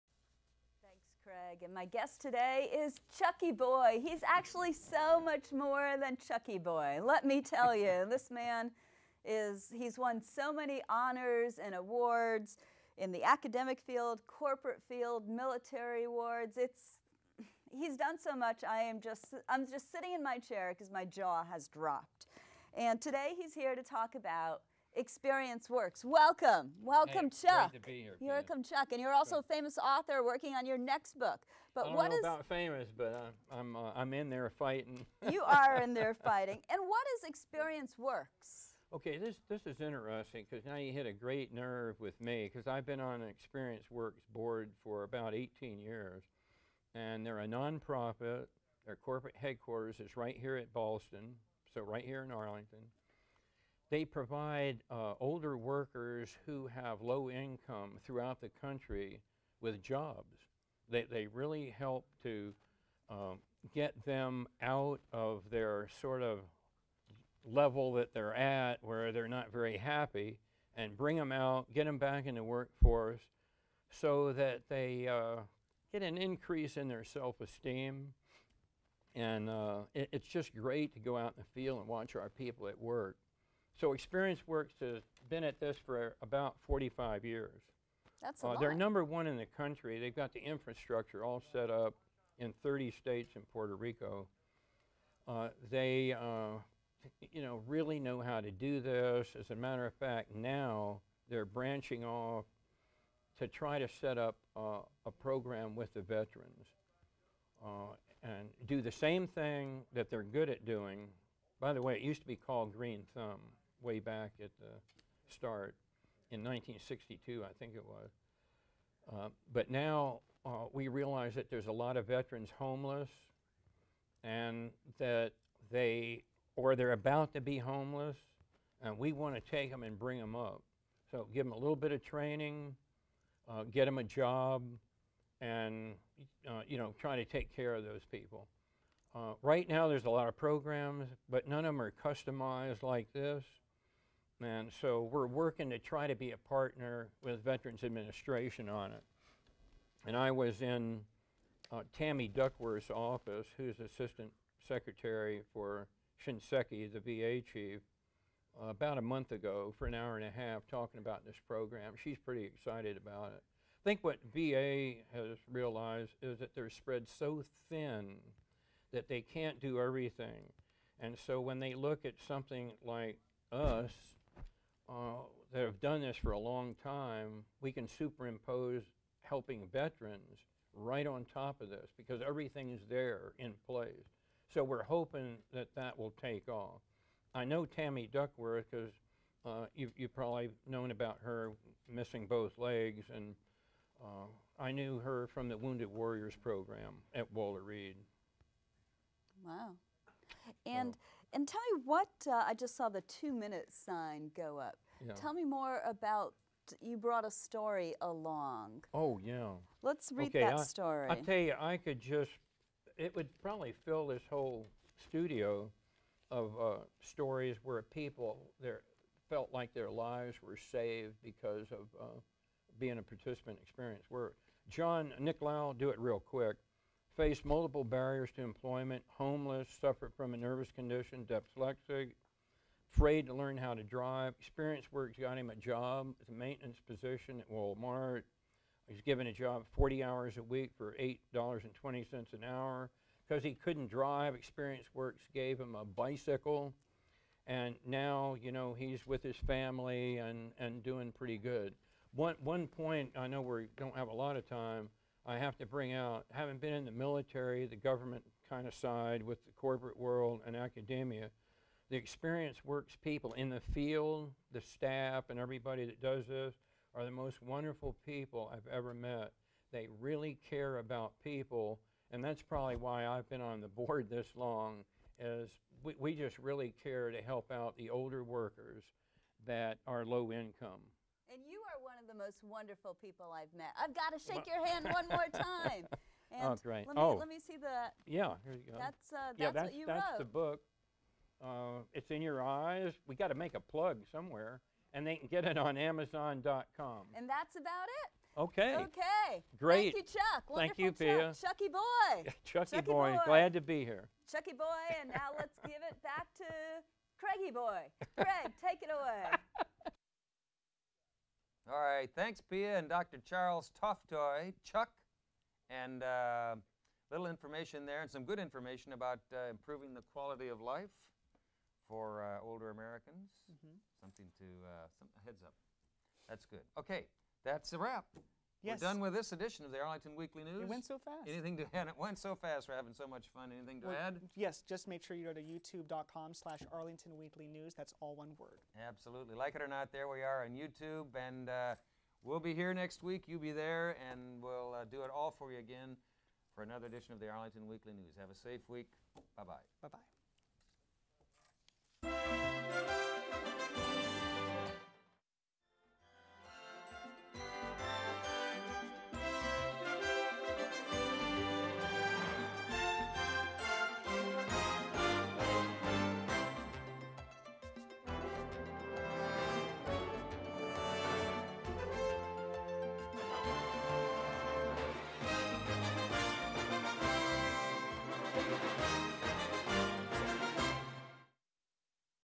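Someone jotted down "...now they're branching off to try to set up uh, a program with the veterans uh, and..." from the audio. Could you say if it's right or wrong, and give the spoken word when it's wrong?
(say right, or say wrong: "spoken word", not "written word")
right.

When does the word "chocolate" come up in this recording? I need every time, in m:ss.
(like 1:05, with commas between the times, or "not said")
not said.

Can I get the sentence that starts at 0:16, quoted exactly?
It's, he's done so much, I am just, I'm just sitting in my chair because my jaw has dropped.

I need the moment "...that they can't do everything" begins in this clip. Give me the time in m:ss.
2:48.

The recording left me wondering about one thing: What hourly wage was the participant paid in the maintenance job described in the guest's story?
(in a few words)
$8.20.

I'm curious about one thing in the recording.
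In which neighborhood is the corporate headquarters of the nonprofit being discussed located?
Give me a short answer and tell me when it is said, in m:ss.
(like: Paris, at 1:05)
Ballston, at 0:50.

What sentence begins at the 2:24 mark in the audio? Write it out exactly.
And so we're working to try to be a partner with Veterans Administration on it.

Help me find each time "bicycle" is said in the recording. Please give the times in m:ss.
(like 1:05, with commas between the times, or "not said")
4:05.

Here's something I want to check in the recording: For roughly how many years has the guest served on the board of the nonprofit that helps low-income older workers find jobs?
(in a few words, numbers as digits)
18 years.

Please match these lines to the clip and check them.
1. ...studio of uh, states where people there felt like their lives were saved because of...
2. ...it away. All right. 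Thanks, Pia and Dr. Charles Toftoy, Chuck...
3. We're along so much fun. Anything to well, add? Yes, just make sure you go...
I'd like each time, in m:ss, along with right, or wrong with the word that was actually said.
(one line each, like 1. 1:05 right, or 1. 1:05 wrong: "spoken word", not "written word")
1. 3:35 wrong: "stories", not "states"
2. 5:08 right
3. 5:32 wrong: "having", not "along".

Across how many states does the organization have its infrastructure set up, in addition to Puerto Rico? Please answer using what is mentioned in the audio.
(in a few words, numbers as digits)
30.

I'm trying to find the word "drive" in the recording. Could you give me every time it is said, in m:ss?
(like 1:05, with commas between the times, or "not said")
3:53, 4:03.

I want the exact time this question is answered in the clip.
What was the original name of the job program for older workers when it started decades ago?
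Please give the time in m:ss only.
1:52.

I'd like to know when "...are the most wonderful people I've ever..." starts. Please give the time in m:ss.
4:26.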